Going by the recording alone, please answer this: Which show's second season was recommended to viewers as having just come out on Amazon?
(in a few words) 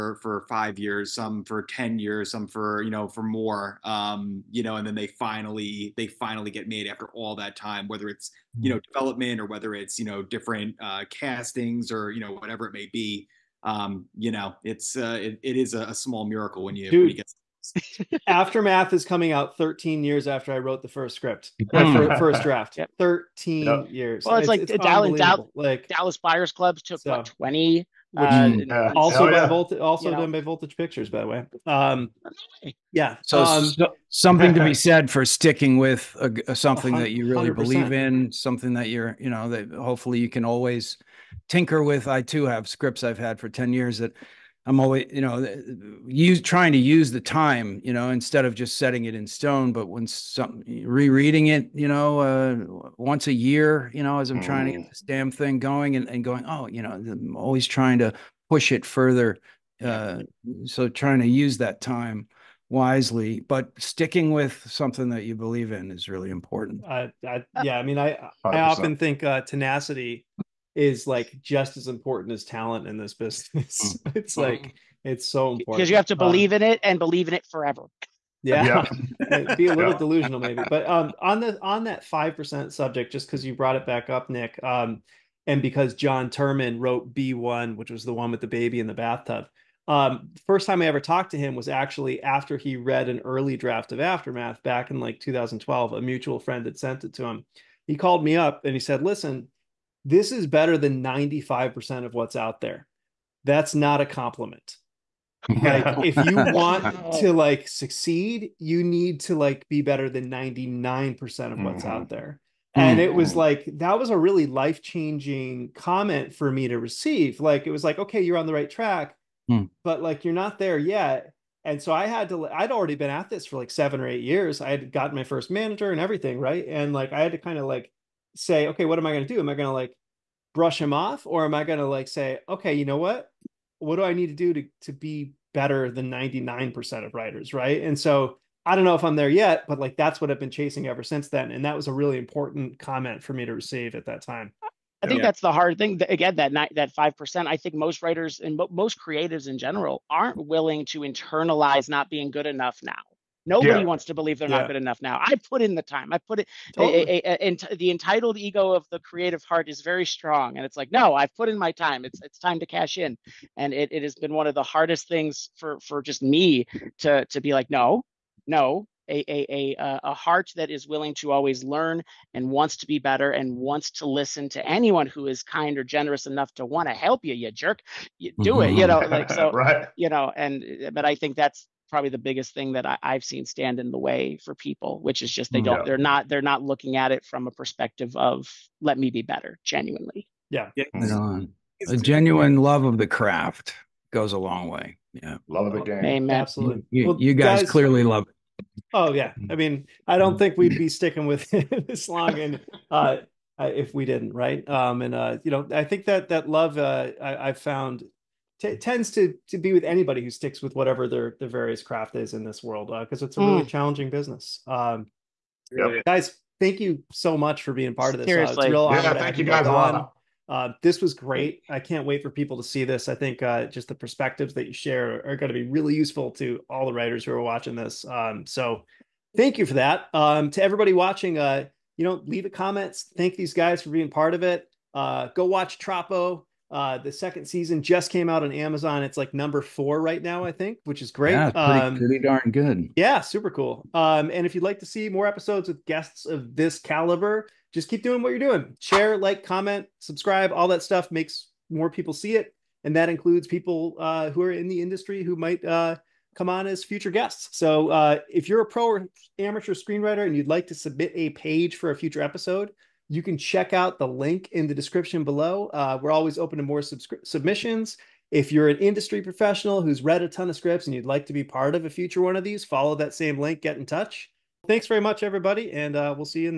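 Troppo.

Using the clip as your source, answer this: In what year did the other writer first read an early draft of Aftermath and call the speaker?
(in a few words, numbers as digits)
2012.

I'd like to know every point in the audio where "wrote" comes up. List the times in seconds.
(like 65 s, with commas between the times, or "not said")
20 s, 86 s.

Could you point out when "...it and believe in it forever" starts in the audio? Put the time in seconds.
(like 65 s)
76 s.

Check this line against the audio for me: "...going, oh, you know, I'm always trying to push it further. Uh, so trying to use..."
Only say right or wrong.
right.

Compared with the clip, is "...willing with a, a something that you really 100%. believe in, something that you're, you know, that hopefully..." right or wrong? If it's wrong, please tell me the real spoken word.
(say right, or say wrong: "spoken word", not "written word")
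wrong: "sticking", not "willing".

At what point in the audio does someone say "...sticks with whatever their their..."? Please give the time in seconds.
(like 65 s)
210 s.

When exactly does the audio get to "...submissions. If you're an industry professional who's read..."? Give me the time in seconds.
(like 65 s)
266 s.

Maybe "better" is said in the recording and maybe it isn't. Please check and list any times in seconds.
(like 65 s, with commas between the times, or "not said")
100 s, 109 s, 135 s, 173 s, 189 s.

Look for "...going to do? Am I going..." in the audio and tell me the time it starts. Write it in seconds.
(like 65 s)
129 s.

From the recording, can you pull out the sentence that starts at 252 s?
And that includes people uh, who are in the industry who might uh, come on as future guests.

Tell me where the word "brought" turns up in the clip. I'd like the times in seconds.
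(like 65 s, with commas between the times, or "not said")
83 s.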